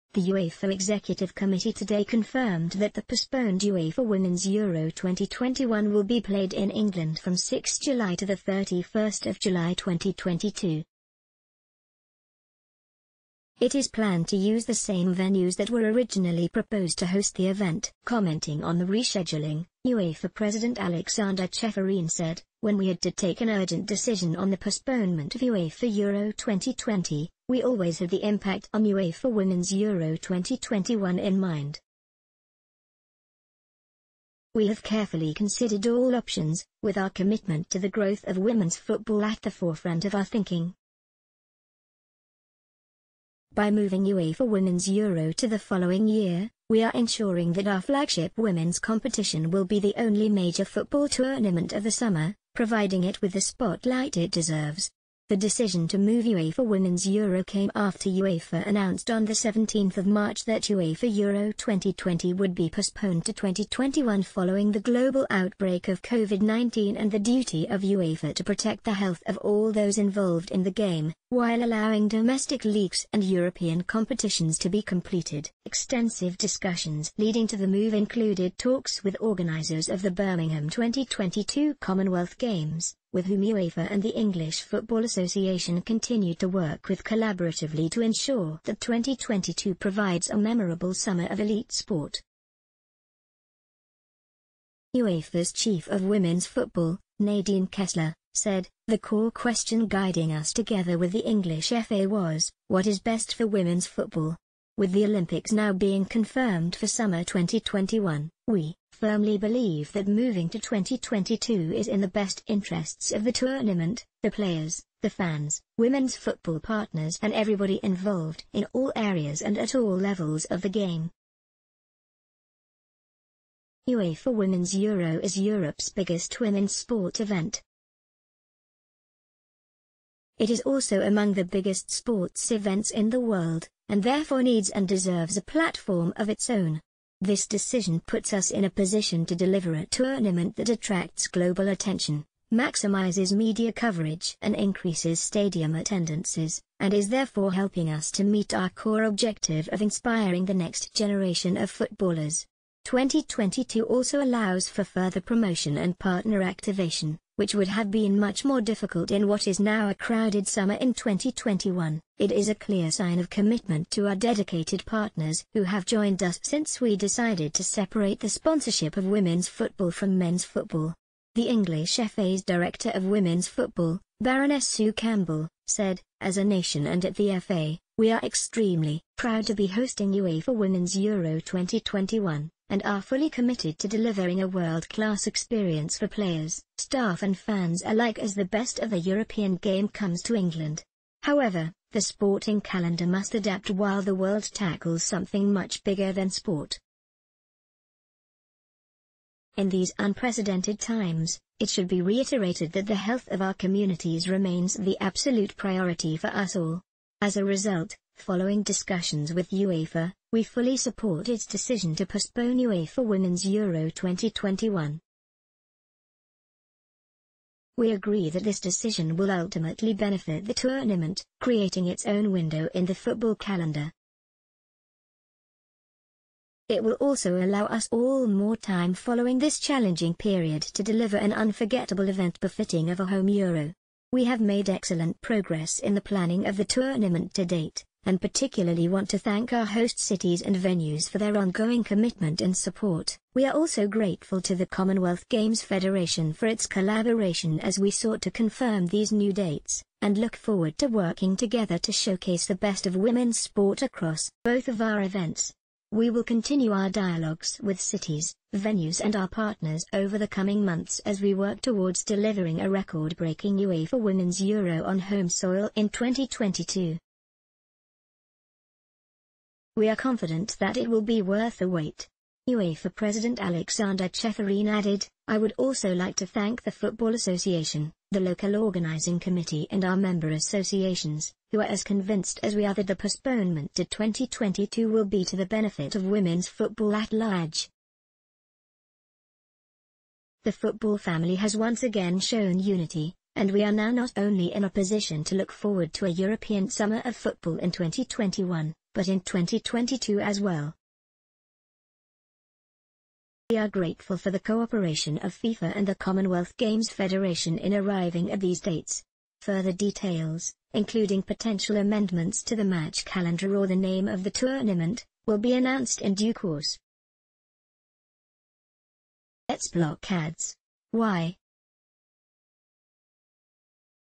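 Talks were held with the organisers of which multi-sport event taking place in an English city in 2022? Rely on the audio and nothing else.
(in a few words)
Birmingham 2022 Commonwealth Games.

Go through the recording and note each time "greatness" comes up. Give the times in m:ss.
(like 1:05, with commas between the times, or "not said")
not said.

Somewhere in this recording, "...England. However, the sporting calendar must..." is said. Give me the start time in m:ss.
3:10.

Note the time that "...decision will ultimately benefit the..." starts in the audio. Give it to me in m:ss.
3:38.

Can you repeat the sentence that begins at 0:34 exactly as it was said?
We have carefully considered all options, with our commitment to the growth of women's football at the forefront of our thinking.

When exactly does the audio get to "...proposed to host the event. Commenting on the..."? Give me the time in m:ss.
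0:16.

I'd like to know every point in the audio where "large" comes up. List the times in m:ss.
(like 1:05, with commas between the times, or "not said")
4:47.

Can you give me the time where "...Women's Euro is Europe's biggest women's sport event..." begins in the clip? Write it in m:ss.
2:04.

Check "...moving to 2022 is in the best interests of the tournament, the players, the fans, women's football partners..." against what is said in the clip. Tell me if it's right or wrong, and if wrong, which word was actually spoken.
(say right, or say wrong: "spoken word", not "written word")
right.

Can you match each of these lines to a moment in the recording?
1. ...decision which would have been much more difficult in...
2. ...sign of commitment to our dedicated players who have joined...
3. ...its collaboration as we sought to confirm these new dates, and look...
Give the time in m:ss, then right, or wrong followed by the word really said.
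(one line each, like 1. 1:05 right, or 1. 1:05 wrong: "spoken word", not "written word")
1. 2:36 wrong: "activation", not "decision"
2. 2:42 wrong: "partners", not "players"
3. 4:06 right.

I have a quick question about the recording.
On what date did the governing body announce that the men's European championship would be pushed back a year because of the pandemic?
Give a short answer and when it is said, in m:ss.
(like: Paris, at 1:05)
17th of March, at 0:59.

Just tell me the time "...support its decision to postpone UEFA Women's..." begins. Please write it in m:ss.
3:30.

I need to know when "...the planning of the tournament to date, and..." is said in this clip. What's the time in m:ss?
3:55.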